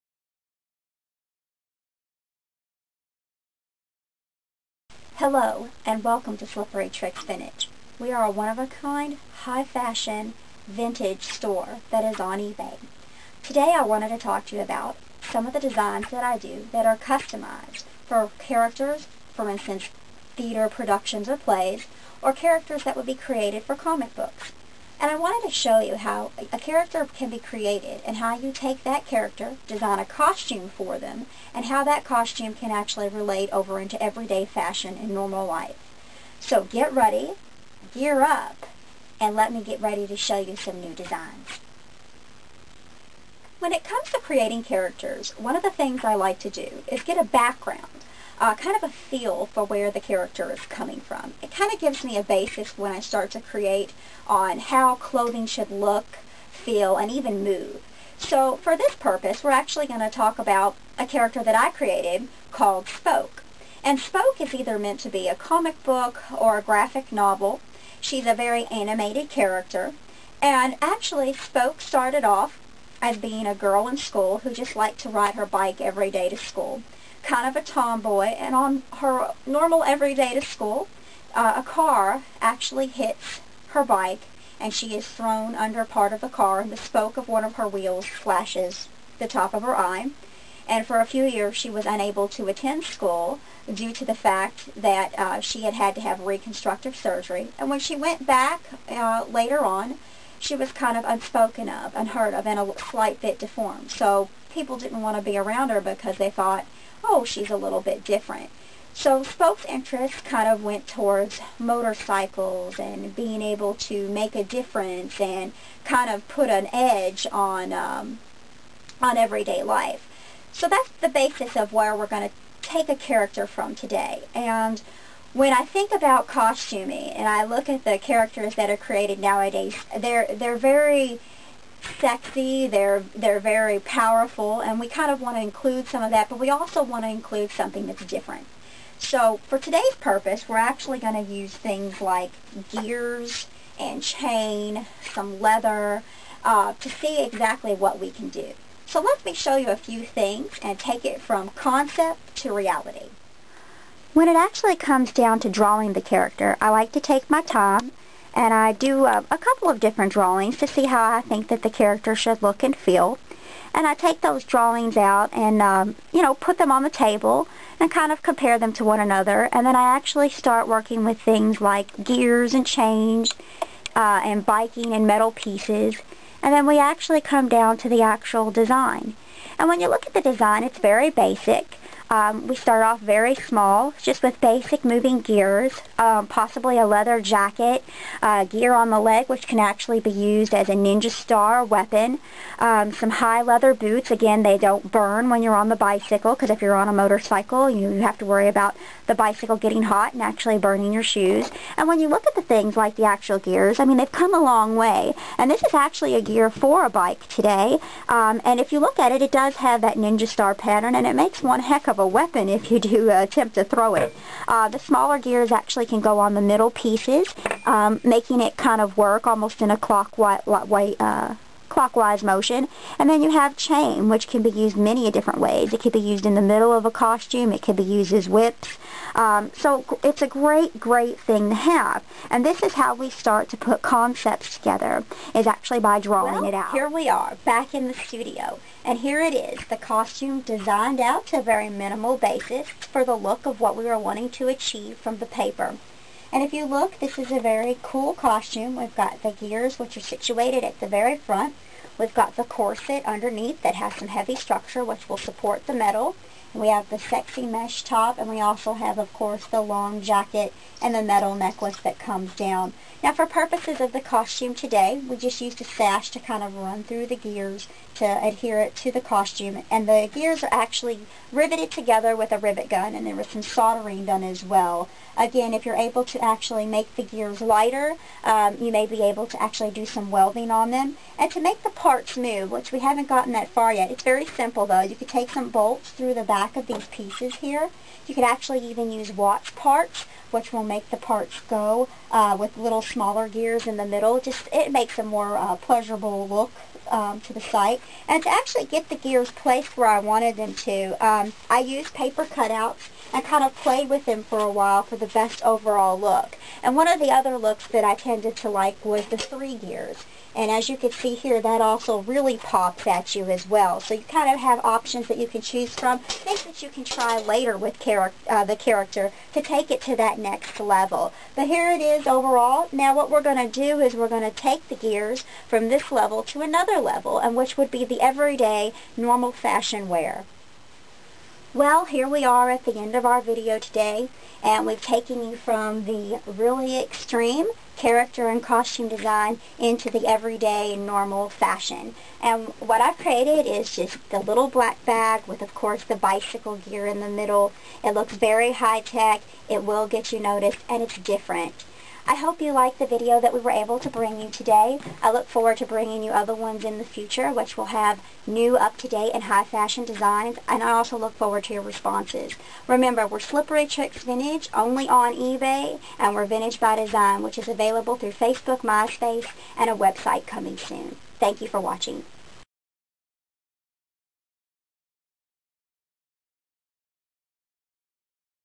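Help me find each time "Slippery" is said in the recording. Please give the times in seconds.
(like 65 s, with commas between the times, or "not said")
6 s, 363 s.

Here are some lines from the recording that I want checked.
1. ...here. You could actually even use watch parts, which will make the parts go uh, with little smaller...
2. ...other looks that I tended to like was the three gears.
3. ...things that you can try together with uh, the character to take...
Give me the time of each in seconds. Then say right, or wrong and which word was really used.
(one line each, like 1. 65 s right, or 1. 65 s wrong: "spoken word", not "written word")
1. 287 s right
2. 307 s right
3. 315 s wrong: "later", not "together".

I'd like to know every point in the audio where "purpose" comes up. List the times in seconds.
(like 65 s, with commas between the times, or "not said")
58 s, 139 s, 263 s.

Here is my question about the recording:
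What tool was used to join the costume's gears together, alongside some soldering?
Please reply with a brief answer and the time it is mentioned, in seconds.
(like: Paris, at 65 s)
Rivet gun, at 272 s.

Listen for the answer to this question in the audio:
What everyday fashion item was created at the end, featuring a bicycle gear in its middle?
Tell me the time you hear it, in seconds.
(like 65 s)
344 s.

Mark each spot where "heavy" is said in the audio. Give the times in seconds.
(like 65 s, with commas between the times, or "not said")
254 s.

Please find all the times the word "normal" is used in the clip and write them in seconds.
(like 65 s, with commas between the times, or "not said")
35 s, 79 s, 328 s, 340 s.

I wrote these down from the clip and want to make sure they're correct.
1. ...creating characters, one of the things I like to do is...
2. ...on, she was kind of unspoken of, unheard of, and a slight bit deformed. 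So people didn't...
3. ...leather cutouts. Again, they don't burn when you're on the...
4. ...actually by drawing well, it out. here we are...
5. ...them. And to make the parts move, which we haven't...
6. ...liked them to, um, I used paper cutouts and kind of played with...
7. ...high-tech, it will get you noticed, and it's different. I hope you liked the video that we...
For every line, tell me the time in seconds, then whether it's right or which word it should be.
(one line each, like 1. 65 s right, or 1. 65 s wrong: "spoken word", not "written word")
1. 44 s right
2. 99 s right
3. 193 s wrong: "boots", not "cutouts"
4. 235 s right
5. 280 s right
6. 299 s wrong: "wanted", not "liked"
7. 348 s right.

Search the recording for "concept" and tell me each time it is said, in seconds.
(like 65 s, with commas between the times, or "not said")
151 s, 233 s.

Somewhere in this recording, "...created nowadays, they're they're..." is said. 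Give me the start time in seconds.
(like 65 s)
128 s.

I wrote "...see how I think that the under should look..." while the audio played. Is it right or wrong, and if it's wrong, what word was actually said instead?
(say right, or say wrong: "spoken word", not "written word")
wrong: "character", not "under".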